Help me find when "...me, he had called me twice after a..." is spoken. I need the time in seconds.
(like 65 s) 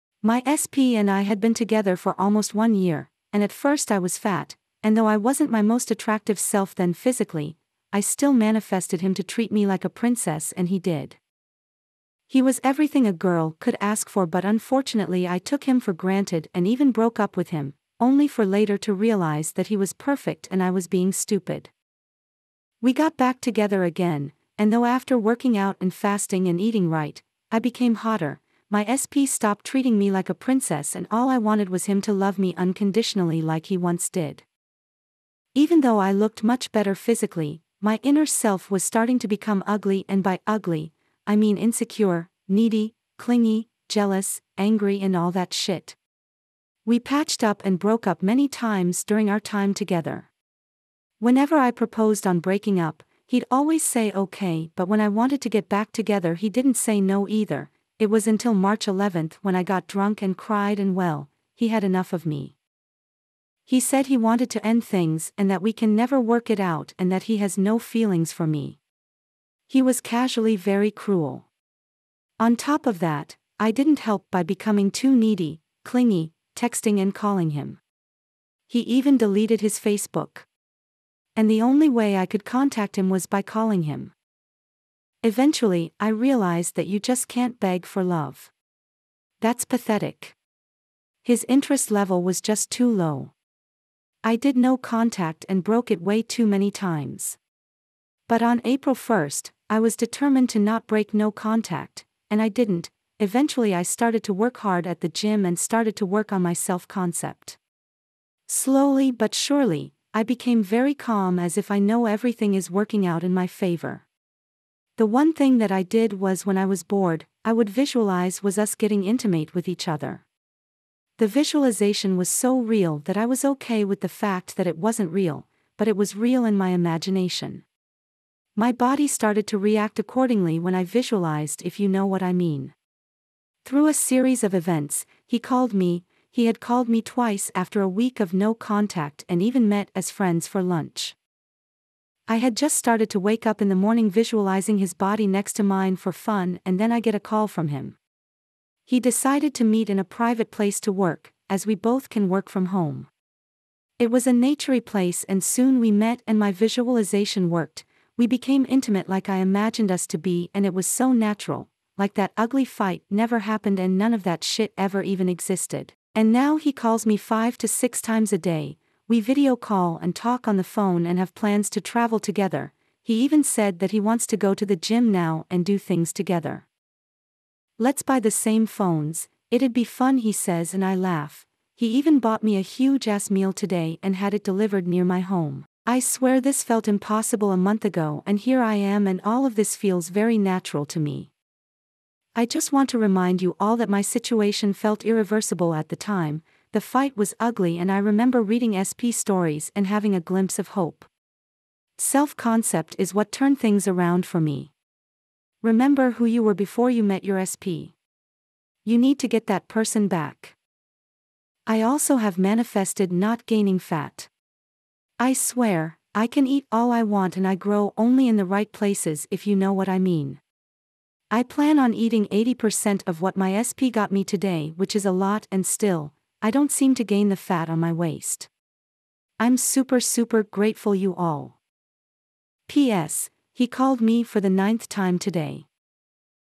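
135 s.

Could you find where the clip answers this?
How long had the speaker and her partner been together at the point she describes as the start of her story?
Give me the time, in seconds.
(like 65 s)
2 s.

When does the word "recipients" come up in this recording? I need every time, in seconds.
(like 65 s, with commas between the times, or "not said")
not said.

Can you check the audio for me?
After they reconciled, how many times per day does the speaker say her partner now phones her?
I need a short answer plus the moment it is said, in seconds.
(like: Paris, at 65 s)
5 to 6, at 167 s.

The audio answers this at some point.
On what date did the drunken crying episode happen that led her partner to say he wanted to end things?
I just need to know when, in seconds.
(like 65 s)
58 s.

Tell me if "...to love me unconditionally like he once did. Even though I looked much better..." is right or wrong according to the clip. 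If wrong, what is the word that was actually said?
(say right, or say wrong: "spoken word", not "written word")
right.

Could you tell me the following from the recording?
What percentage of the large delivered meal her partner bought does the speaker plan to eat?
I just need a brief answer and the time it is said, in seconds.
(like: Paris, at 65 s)
80%, at 222 s.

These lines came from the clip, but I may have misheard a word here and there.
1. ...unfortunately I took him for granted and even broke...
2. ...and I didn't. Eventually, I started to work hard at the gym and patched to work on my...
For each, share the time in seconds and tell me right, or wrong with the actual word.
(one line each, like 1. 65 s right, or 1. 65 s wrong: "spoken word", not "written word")
1. 14 s right
2. 102 s wrong: "started", not "patched".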